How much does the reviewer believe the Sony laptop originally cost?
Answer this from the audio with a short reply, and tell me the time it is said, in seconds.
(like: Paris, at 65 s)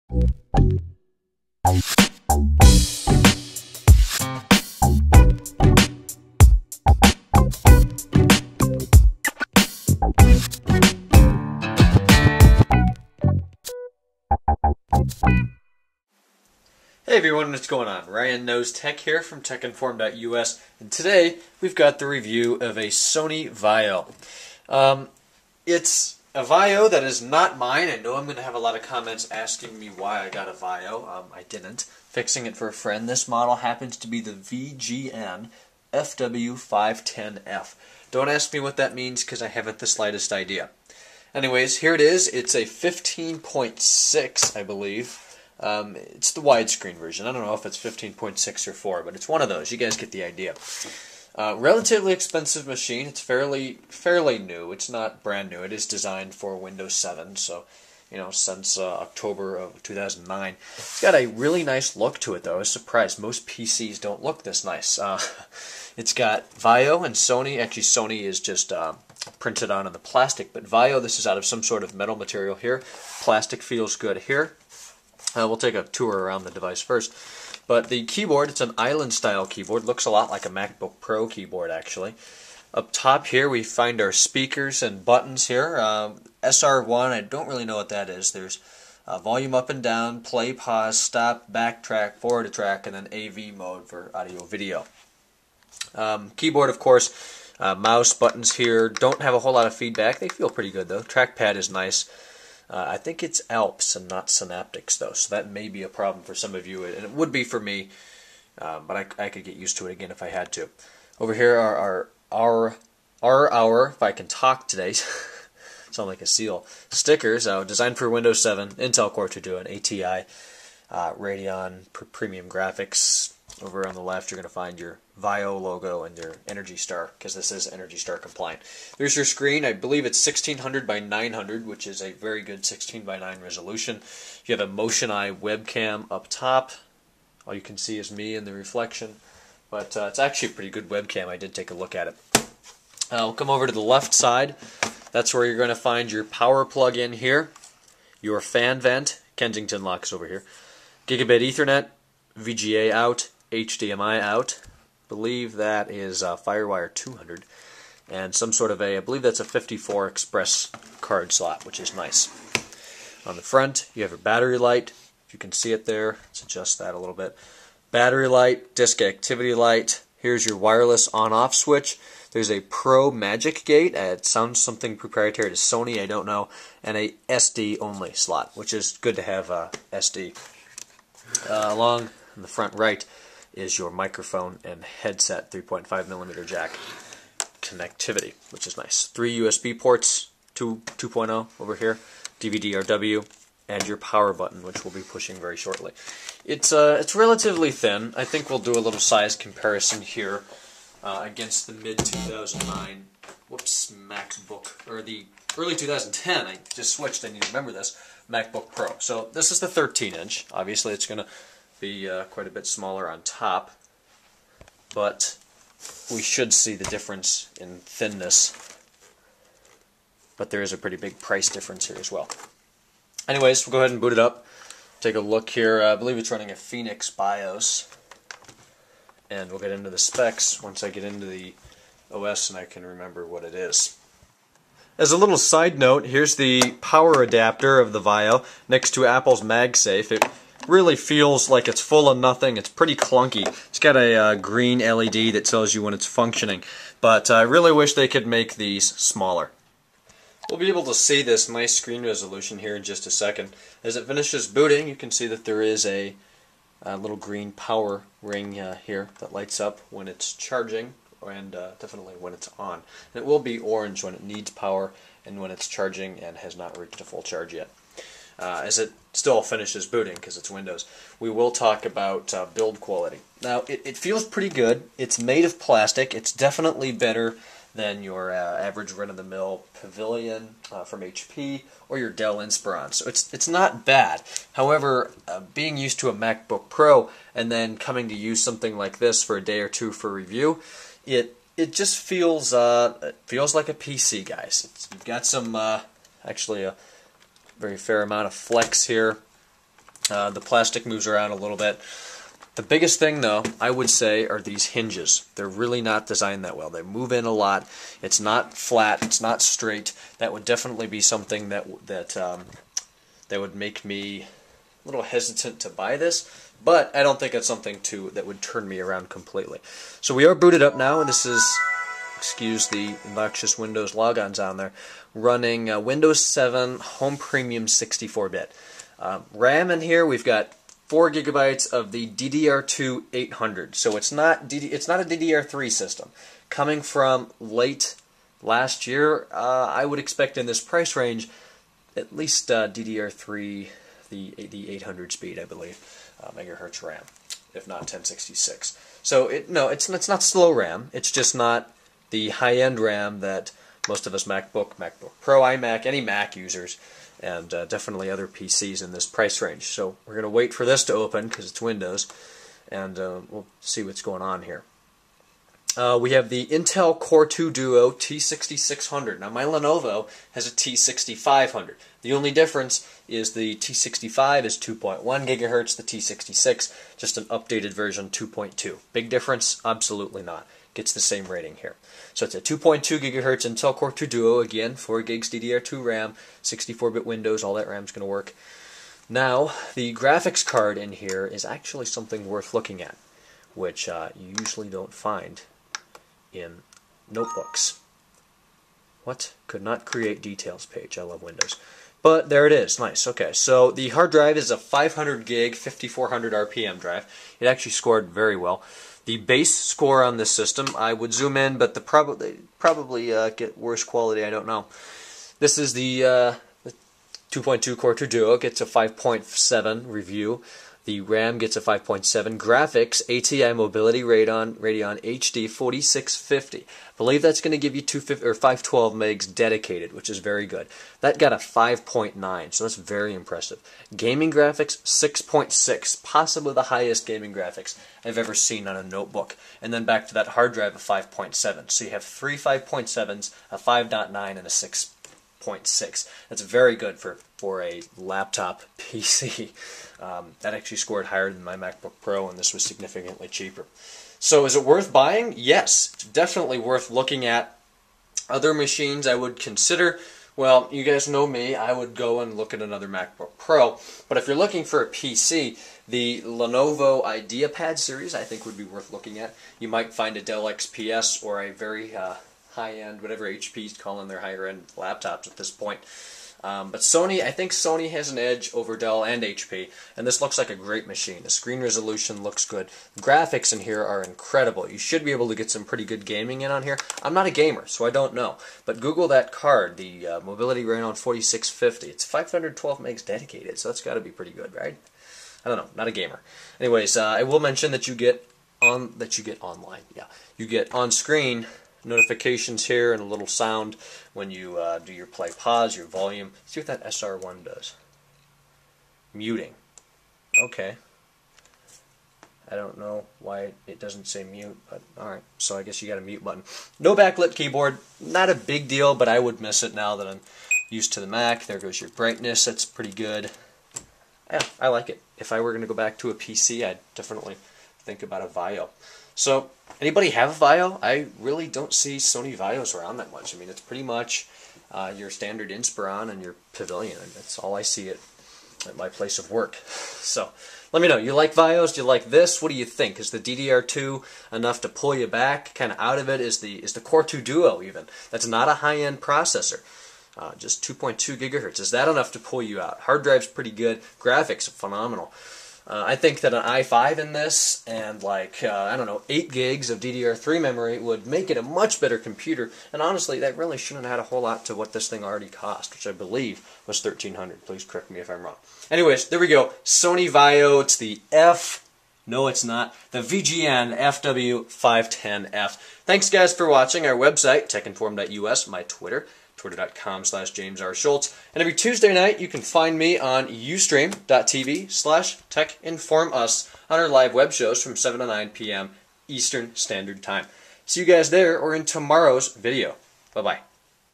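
$1300, at 566 s.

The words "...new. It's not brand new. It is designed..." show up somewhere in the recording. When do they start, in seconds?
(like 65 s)
54 s.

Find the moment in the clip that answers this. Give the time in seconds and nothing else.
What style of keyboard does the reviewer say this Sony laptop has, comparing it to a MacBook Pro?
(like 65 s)
78 s.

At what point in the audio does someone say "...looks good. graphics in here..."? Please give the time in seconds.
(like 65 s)
482 s.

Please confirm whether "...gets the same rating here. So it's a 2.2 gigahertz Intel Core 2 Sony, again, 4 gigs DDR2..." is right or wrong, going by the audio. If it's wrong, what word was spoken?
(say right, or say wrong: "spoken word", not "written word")
wrong: "Duo", not "Sony".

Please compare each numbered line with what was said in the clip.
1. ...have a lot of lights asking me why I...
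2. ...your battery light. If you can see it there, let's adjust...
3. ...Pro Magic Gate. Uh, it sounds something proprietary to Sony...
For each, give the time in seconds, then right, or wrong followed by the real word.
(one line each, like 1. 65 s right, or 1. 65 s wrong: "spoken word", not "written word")
1. 28 s wrong: "comments", not "lights"
2. 164 s right
3. 172 s right.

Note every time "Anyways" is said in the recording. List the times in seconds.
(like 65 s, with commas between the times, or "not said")
41 s, 223 s, 496 s, 568 s.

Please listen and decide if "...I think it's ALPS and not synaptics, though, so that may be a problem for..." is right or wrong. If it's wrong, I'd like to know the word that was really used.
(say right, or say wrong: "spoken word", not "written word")
right.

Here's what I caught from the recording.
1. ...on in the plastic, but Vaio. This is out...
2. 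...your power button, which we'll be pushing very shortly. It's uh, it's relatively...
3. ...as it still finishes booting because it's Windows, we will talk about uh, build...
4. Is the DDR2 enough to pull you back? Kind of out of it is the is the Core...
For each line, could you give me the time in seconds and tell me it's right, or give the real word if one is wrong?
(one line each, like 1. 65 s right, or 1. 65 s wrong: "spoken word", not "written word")
1. 69 s right
2. 193 s right
3. 268 s right
4. 542 s right.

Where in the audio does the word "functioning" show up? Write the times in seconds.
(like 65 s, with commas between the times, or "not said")
246 s.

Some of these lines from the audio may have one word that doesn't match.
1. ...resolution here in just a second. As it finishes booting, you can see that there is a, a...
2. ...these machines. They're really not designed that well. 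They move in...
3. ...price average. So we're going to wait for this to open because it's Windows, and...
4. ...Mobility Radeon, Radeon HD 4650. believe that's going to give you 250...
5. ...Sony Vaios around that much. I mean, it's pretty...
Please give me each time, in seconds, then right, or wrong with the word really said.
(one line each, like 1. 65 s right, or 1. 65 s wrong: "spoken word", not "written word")
1. 252 s right
2. 304 s wrong: "hinges", not "machines"
3. 359 s wrong: "range", not "average"
4. 423 s right
5. 531 s right.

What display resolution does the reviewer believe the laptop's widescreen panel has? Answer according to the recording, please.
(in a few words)
1600 by 900.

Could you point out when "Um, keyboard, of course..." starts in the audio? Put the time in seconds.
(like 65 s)
95 s.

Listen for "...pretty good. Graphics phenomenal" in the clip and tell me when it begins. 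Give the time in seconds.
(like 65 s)
553 s.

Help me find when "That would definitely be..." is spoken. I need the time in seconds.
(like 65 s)
310 s.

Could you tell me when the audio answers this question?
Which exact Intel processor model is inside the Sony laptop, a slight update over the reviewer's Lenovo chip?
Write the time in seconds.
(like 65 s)
366 s.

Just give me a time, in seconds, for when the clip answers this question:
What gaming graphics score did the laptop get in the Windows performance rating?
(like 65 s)
434 s.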